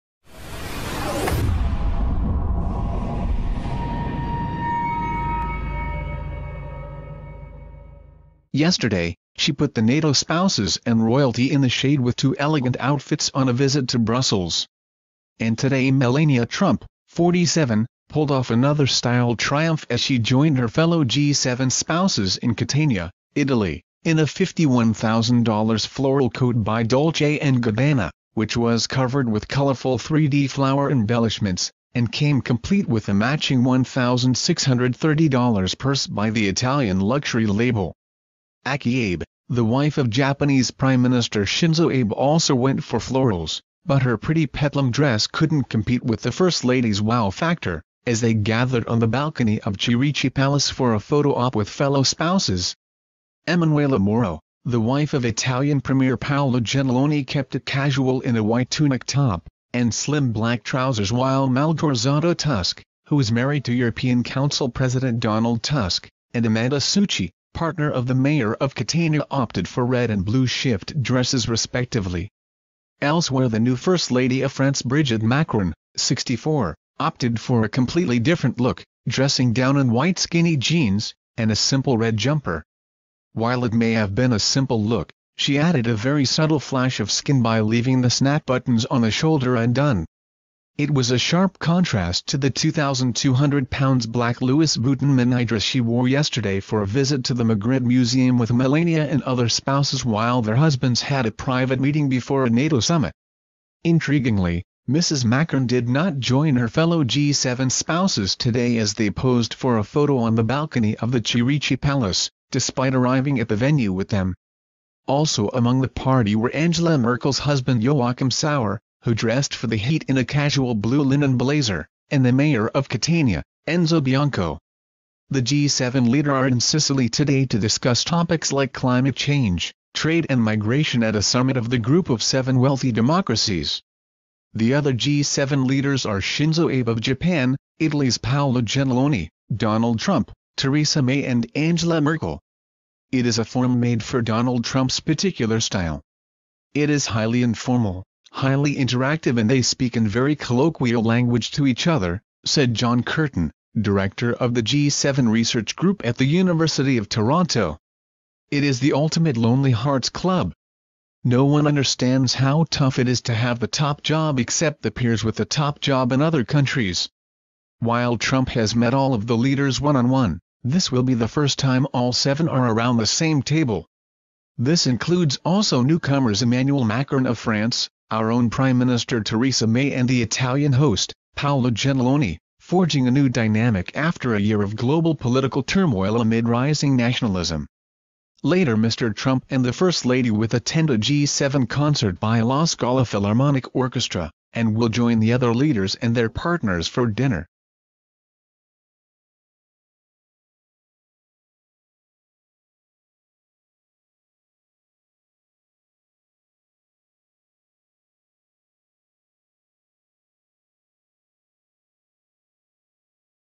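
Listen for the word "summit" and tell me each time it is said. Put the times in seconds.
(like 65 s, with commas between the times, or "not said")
102 s, 131 s.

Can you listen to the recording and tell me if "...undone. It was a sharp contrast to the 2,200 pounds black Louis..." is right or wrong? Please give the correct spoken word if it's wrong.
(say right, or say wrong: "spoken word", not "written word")
right.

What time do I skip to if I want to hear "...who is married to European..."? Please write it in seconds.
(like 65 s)
63 s.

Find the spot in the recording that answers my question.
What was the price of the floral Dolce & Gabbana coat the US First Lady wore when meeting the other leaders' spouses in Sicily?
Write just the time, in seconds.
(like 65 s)
24 s.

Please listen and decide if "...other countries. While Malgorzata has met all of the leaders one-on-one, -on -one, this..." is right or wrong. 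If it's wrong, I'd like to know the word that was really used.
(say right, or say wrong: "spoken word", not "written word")
wrong: "Trump", not "Malgorzata".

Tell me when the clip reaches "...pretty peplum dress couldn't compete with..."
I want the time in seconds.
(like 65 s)
44 s.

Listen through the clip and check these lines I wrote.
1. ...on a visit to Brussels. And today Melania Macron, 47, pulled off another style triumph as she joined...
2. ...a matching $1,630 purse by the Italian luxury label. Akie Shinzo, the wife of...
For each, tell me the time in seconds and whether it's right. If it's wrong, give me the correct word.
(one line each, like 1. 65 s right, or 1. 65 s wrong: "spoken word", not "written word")
1. 13 s wrong: "Trump", not "Macron"
2. 33 s wrong: "Abe", not "Shinzo".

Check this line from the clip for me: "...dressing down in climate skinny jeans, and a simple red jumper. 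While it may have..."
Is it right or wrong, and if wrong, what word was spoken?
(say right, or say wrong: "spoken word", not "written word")
wrong: "white", not "climate".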